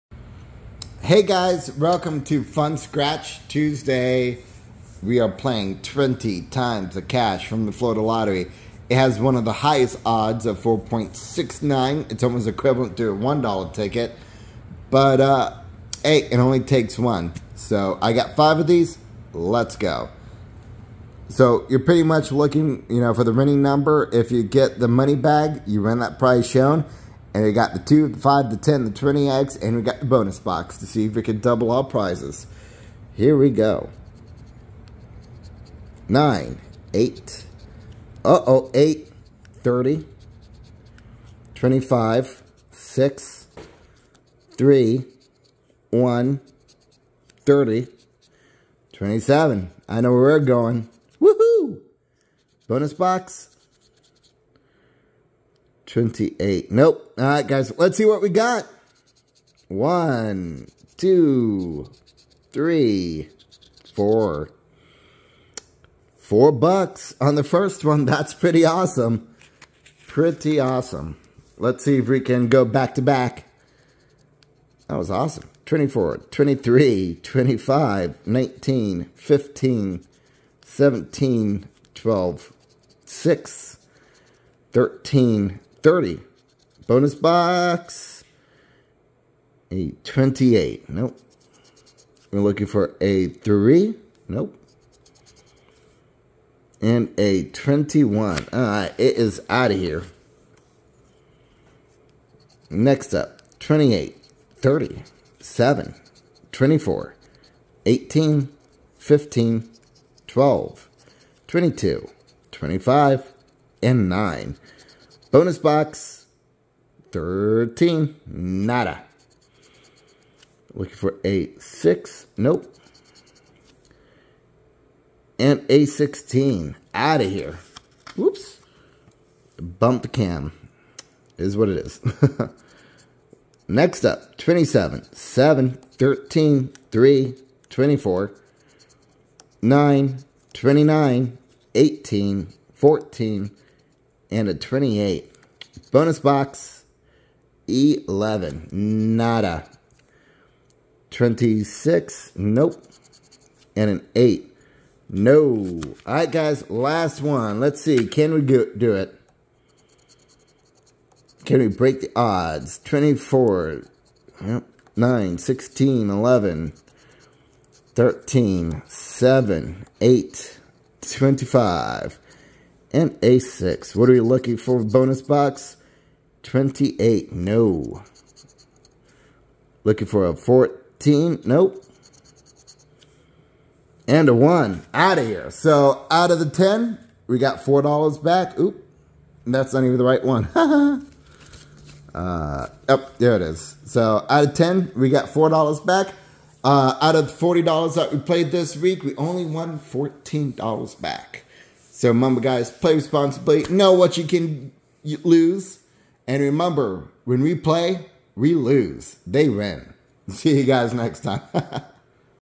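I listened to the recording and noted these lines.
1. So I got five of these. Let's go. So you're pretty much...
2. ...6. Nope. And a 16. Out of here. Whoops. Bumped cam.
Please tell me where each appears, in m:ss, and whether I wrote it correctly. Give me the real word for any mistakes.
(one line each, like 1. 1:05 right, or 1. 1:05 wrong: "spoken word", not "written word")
1. 0:17 right
2. 2:01 right.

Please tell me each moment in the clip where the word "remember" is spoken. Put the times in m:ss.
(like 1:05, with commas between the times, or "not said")
3:22, 3:26.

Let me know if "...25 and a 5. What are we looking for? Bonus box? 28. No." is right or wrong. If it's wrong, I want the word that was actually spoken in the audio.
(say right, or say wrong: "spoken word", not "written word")
wrong: "6", not "5".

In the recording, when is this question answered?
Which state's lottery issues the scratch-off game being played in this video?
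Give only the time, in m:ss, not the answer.
0:07.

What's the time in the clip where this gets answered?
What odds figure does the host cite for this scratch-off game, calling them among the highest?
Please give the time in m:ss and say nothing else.
0:10.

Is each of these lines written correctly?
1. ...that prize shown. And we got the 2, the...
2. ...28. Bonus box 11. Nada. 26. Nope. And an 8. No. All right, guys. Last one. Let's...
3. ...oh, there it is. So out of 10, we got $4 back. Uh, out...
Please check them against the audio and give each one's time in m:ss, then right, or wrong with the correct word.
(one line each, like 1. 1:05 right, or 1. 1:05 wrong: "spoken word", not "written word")
1. 0:25 right
2. 2:24 right
3. 3:12 right.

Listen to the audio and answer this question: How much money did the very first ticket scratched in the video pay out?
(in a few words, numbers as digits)
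$4.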